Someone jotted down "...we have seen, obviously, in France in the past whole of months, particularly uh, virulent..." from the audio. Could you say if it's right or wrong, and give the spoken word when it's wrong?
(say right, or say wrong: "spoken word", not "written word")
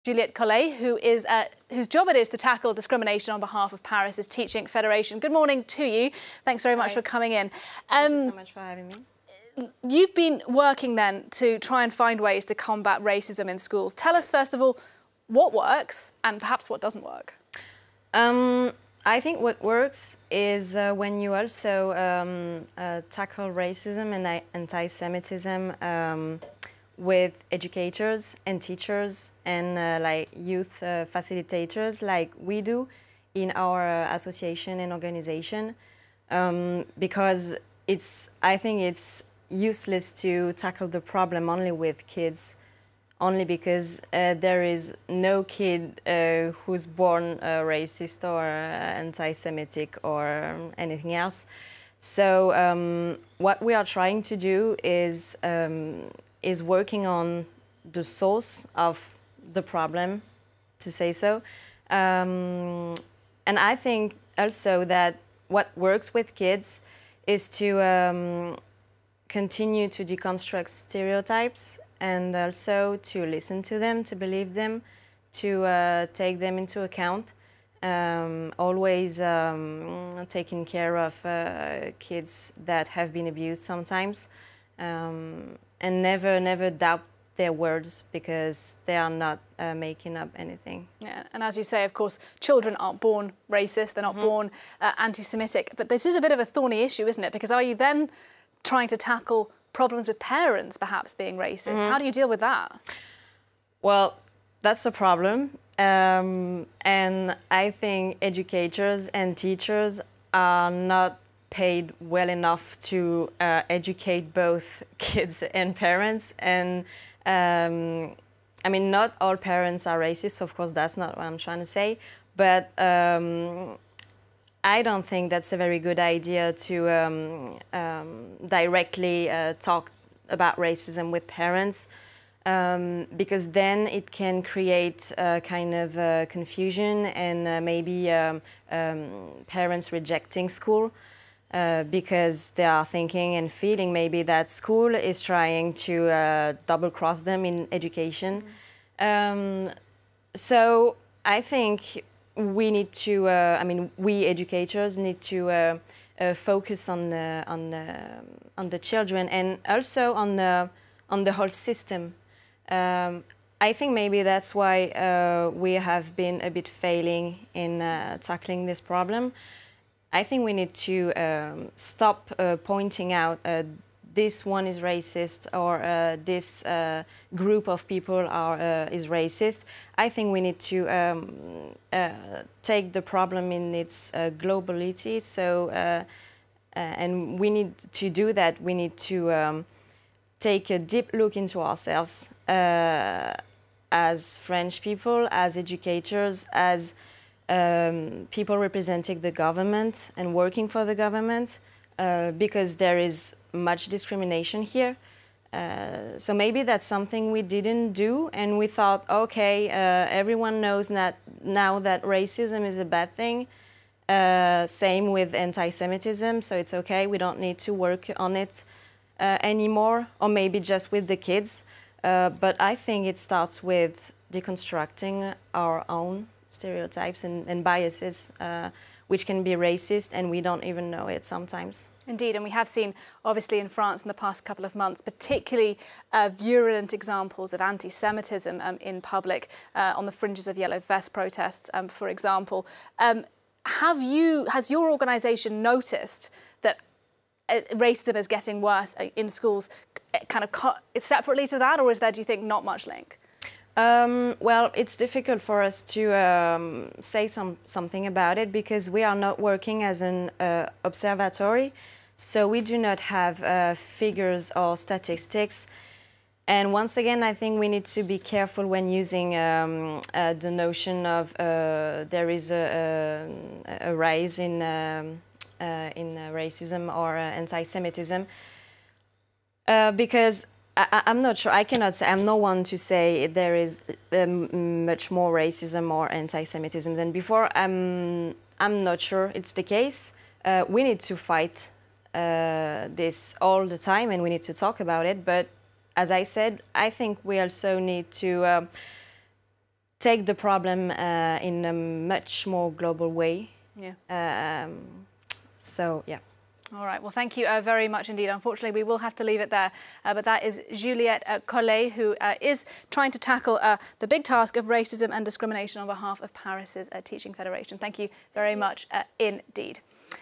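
wrong: "couple", not "whole".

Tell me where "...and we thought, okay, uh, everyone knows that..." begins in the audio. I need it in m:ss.
3:28.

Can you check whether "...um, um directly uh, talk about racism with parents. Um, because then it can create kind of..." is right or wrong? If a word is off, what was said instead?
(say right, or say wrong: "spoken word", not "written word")
right.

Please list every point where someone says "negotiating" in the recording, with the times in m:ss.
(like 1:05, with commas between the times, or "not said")
not said.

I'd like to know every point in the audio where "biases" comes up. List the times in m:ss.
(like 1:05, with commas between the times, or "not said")
3:47.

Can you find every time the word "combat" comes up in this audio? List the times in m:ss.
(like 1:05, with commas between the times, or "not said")
0:12.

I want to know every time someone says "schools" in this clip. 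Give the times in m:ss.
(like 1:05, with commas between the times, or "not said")
0:13, 2:20, 2:24, 4:09.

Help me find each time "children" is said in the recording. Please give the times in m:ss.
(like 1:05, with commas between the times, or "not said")
1:32, 2:38.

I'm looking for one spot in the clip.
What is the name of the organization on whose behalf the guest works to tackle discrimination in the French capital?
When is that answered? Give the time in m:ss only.
0:03.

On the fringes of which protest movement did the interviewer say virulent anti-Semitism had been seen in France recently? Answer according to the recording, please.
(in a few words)
yellow vest protests.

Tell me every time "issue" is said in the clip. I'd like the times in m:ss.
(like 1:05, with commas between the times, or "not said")
1:36.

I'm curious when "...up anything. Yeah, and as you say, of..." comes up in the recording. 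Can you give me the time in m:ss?
1:30.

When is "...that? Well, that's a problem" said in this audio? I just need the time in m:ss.
1:42.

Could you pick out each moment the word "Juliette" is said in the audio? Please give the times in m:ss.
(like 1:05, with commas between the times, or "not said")
0:00, 5:10.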